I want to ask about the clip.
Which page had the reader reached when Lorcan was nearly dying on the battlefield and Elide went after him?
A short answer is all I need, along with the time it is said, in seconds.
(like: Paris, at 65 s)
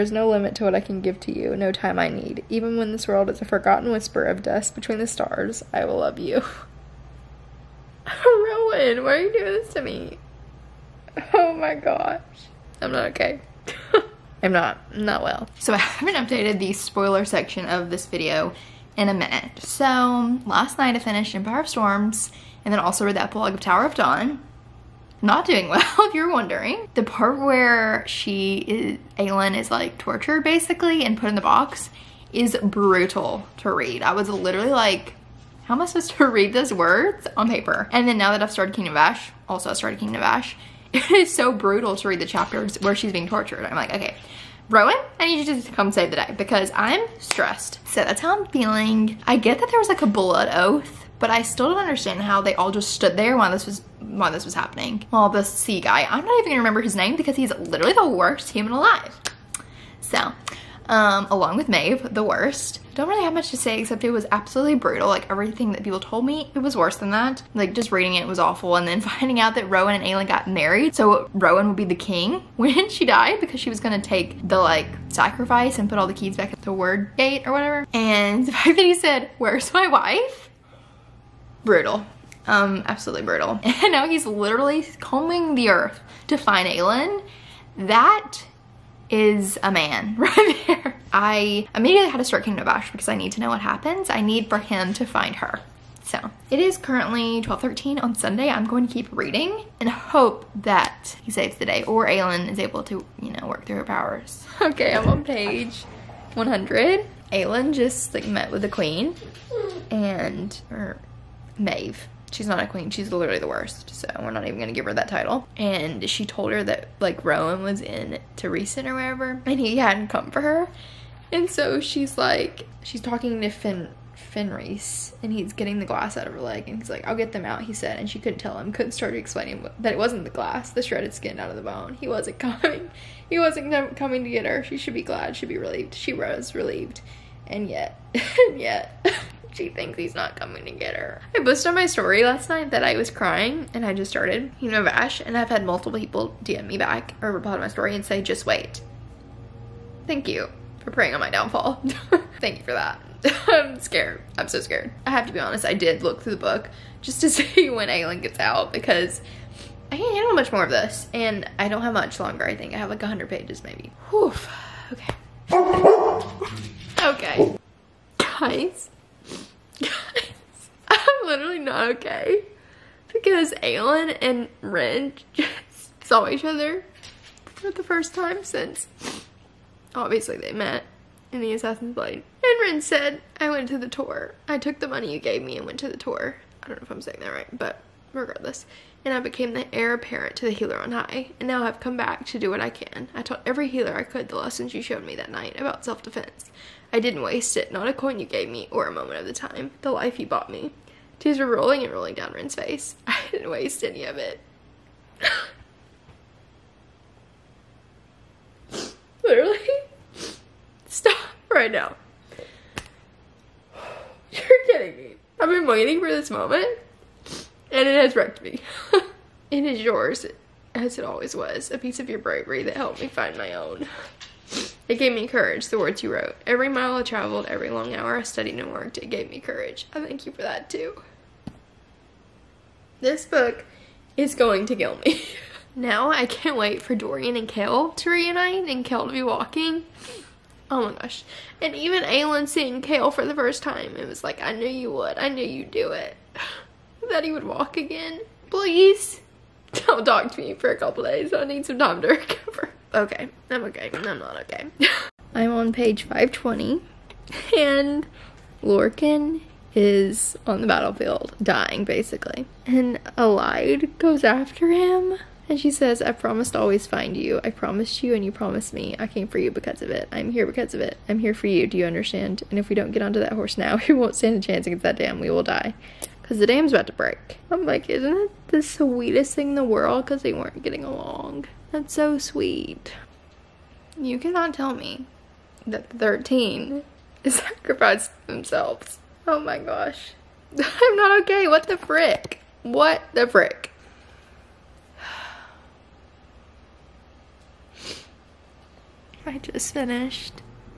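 520, at 255 s.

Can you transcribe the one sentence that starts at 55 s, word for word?
While the sea guy, I'm not even gonna remember his name because he's literally the worst human alive.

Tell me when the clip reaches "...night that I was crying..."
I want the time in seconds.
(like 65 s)
142 s.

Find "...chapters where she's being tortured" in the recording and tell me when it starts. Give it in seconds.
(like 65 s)
42 s.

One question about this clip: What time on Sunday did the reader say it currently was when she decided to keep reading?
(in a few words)
12:13.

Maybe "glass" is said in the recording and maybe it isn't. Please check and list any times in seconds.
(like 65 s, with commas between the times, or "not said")
125 s, 130 s.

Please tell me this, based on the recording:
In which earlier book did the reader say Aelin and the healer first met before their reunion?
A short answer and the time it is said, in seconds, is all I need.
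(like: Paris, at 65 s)
The Assassin's Blade, at 181 s.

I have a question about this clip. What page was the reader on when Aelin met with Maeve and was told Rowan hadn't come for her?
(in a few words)
100.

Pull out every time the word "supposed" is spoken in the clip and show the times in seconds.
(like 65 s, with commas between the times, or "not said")
35 s.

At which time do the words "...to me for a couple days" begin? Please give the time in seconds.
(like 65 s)
250 s.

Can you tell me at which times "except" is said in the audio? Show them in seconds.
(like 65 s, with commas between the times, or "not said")
63 s.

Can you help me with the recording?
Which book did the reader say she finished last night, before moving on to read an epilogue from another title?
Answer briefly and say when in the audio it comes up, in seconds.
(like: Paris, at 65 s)
Empire of Storms, at 21 s.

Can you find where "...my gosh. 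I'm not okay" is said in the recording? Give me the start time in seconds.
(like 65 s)
11 s.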